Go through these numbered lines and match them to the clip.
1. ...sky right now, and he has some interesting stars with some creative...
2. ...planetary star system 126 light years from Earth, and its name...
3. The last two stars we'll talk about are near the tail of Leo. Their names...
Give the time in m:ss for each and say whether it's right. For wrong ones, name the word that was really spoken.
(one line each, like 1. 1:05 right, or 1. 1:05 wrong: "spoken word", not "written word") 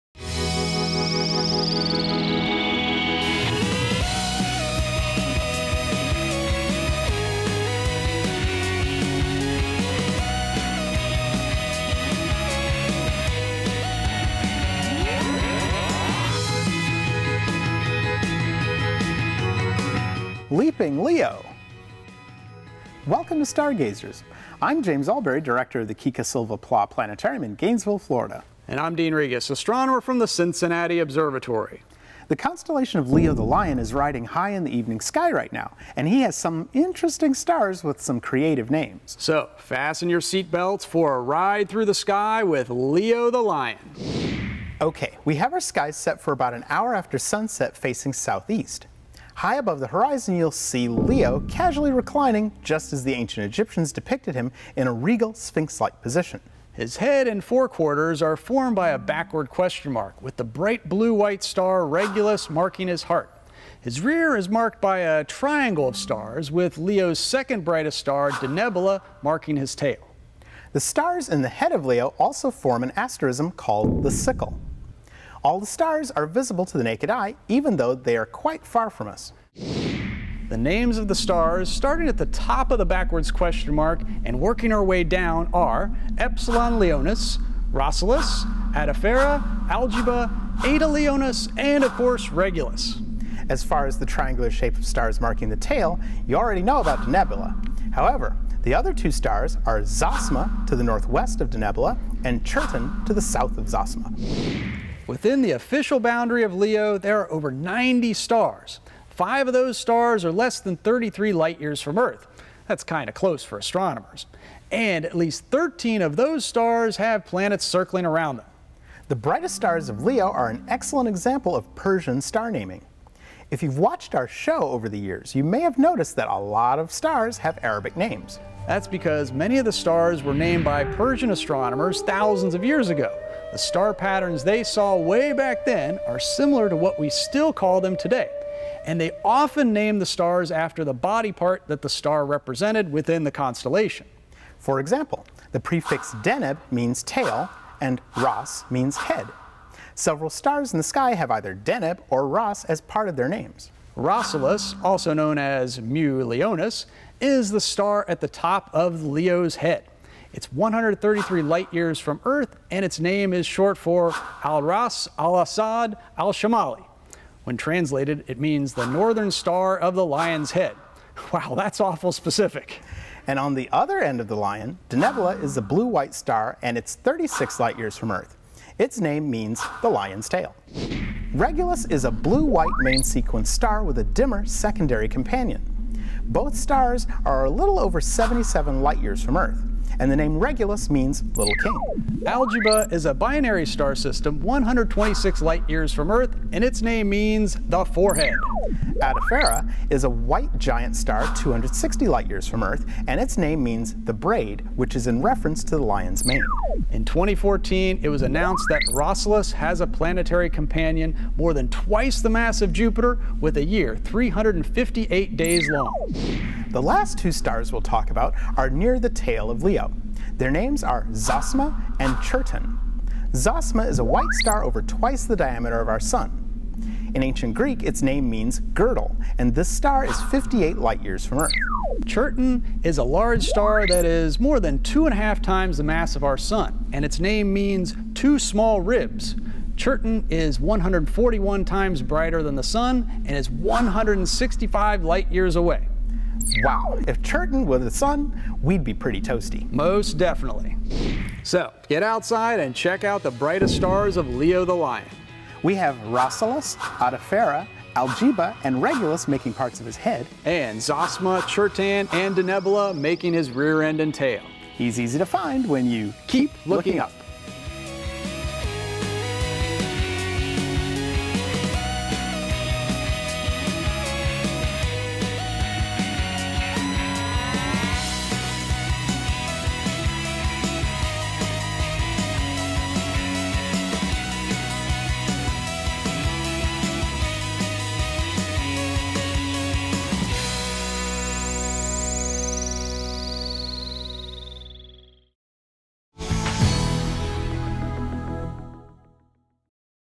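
1. 0:34 right
2. 3:13 wrong: "binary", not "planetary"
3. 3:36 right.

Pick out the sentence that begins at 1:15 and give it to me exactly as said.
All the stars are visible to the naked eye, even though they are quite far from us.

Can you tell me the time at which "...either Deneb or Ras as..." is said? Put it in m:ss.
2:31.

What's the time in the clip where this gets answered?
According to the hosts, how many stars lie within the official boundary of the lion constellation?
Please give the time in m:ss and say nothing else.
1:47.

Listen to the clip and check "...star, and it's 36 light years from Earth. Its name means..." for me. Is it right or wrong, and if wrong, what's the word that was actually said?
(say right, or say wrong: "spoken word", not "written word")
right.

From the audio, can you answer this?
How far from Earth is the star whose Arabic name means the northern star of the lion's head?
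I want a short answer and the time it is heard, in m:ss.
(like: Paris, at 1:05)
133 light years, at 2:40.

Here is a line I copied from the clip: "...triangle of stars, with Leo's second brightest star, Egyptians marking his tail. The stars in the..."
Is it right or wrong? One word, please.
wrong.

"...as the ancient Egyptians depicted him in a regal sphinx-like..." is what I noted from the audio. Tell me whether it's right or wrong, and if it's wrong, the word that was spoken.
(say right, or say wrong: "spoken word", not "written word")
right.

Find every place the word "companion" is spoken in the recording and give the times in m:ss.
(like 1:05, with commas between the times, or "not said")
3:05, 3:30.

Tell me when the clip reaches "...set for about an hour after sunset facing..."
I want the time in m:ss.
0:45.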